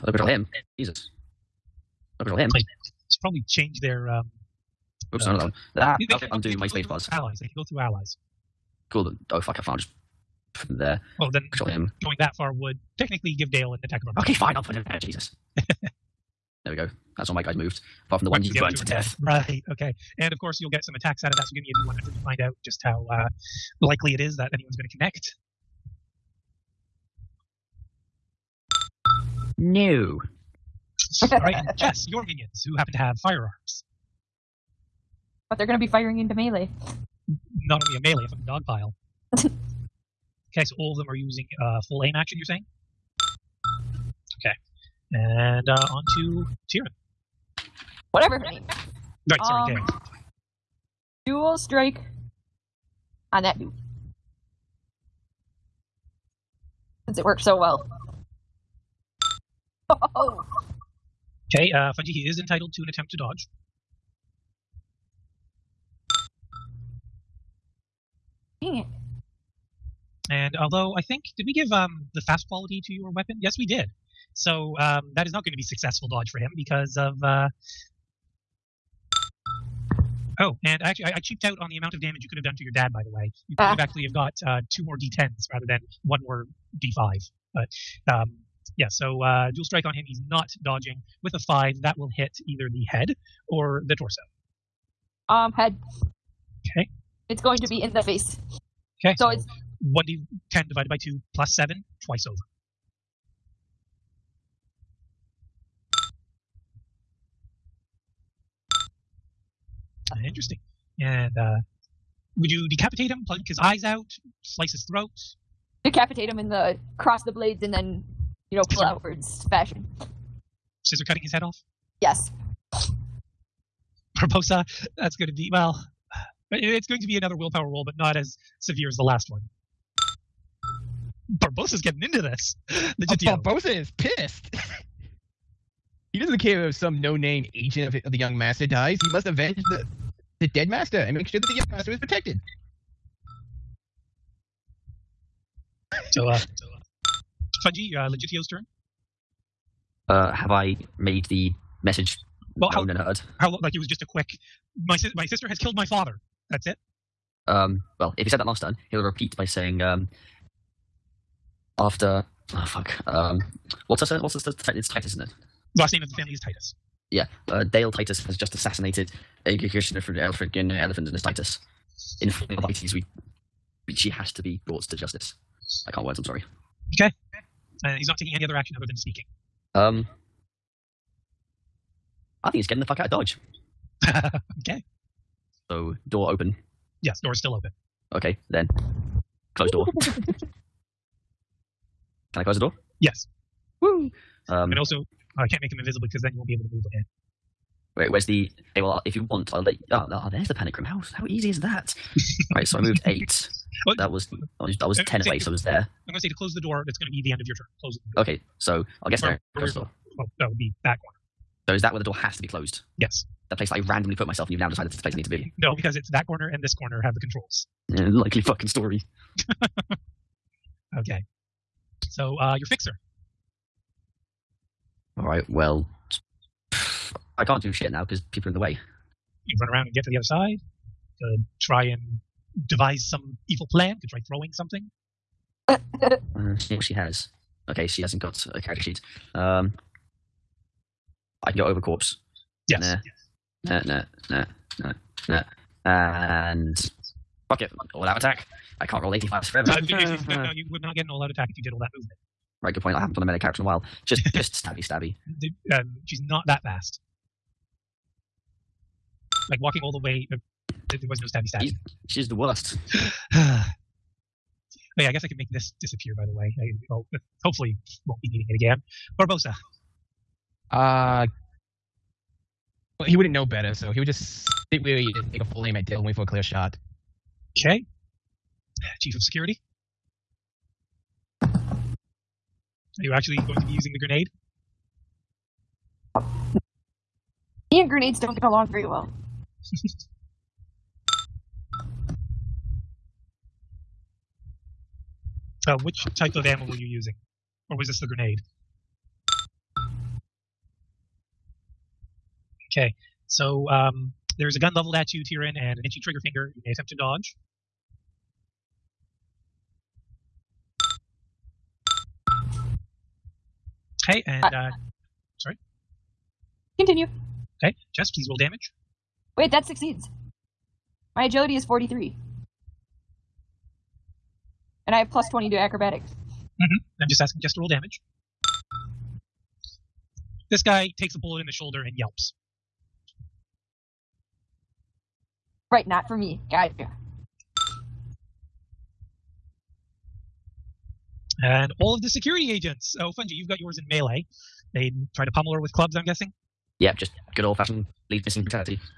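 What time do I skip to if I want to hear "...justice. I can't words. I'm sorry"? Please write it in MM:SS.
02:54.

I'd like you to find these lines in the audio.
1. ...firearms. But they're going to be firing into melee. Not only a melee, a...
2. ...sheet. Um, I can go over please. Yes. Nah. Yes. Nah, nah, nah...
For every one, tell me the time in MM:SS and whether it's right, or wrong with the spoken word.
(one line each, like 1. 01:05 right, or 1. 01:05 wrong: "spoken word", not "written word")
1. 00:33 right
2. 03:58 wrong: "corpse", not "please".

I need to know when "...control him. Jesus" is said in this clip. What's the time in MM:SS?
00:00.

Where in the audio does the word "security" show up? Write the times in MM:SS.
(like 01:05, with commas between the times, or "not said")
04:39, 05:42.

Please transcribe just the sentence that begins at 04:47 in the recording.
Me and grenades don't get along very well.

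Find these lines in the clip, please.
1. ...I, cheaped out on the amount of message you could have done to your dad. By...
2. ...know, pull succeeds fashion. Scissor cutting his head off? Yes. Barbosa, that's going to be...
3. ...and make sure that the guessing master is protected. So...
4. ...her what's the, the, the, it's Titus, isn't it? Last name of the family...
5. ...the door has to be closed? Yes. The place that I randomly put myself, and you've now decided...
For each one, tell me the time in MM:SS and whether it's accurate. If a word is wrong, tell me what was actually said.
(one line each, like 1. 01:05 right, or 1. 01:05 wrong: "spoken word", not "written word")
1. 01:21 wrong: "damage", not "message"
2. 01:58 wrong: "outwards", not "succeeds"
3. 02:20 wrong: "young", not "guessing"
4. 02:43 right
5. 03:31 right.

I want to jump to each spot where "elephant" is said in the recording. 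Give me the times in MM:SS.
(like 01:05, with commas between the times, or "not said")
02:50.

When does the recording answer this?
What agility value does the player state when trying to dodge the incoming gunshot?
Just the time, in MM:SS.
05:21.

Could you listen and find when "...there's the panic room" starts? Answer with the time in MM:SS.
03:20.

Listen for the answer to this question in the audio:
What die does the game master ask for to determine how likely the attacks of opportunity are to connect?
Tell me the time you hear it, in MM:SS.
00:21.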